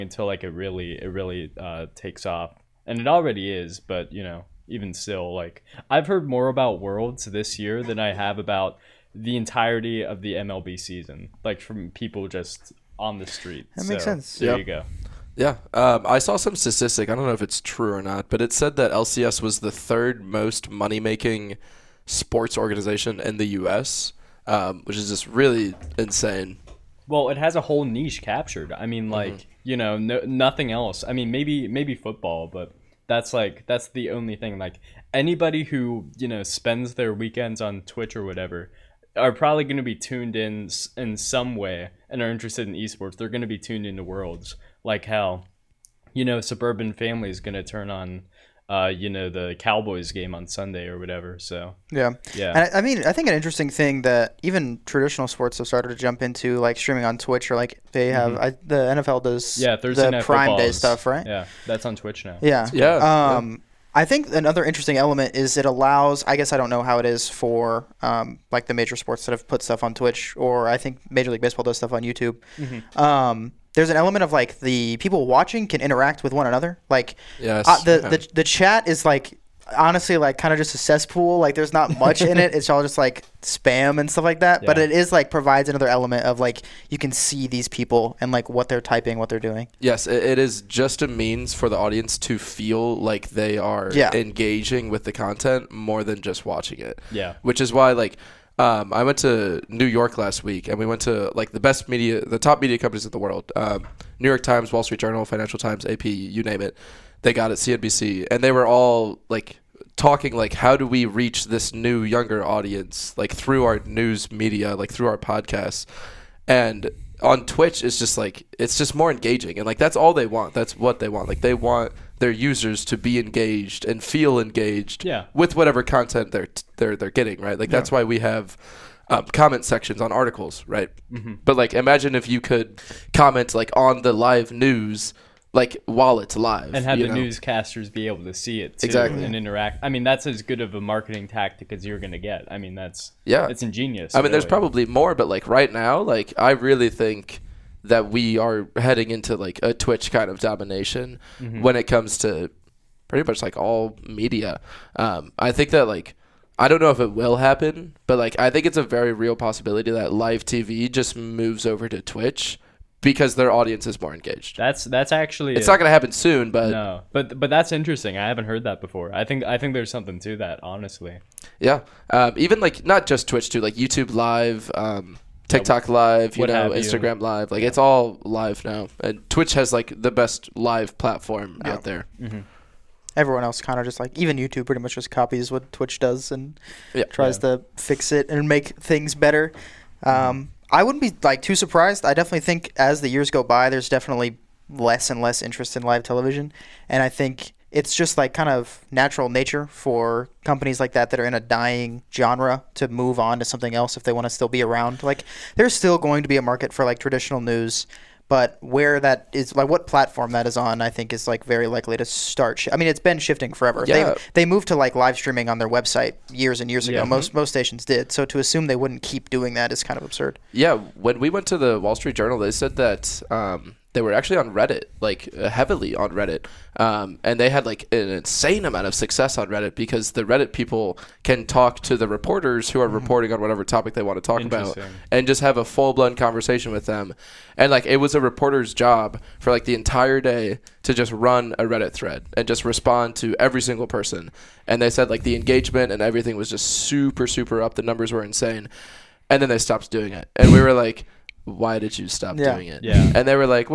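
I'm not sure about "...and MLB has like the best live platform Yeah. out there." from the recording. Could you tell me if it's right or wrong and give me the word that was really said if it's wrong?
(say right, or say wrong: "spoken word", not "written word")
wrong: "Twitch", not "MLB".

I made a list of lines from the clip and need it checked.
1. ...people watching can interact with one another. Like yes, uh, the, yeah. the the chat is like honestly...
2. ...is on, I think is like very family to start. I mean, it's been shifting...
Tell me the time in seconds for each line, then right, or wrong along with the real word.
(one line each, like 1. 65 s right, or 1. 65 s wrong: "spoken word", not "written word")
1. 74 s right
2. 210 s wrong: "likely", not "family".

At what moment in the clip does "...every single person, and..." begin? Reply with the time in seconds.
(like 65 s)
243 s.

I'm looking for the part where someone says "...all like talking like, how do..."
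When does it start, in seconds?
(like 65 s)
108 s.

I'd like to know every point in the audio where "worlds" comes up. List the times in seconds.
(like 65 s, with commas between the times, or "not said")
6 s, 44 s, 103 s.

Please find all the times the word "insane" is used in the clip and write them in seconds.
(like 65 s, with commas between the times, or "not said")
25 s, 228 s, 248 s.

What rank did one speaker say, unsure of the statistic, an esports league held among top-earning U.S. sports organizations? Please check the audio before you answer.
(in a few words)
third.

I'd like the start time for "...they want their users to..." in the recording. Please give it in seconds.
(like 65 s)
121 s.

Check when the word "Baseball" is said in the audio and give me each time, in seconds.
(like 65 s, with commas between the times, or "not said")
71 s.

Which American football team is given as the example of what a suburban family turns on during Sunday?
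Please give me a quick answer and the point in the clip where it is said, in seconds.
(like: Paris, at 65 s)
the Cowboys, at 49 s.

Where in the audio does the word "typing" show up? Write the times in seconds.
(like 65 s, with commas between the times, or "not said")
88 s.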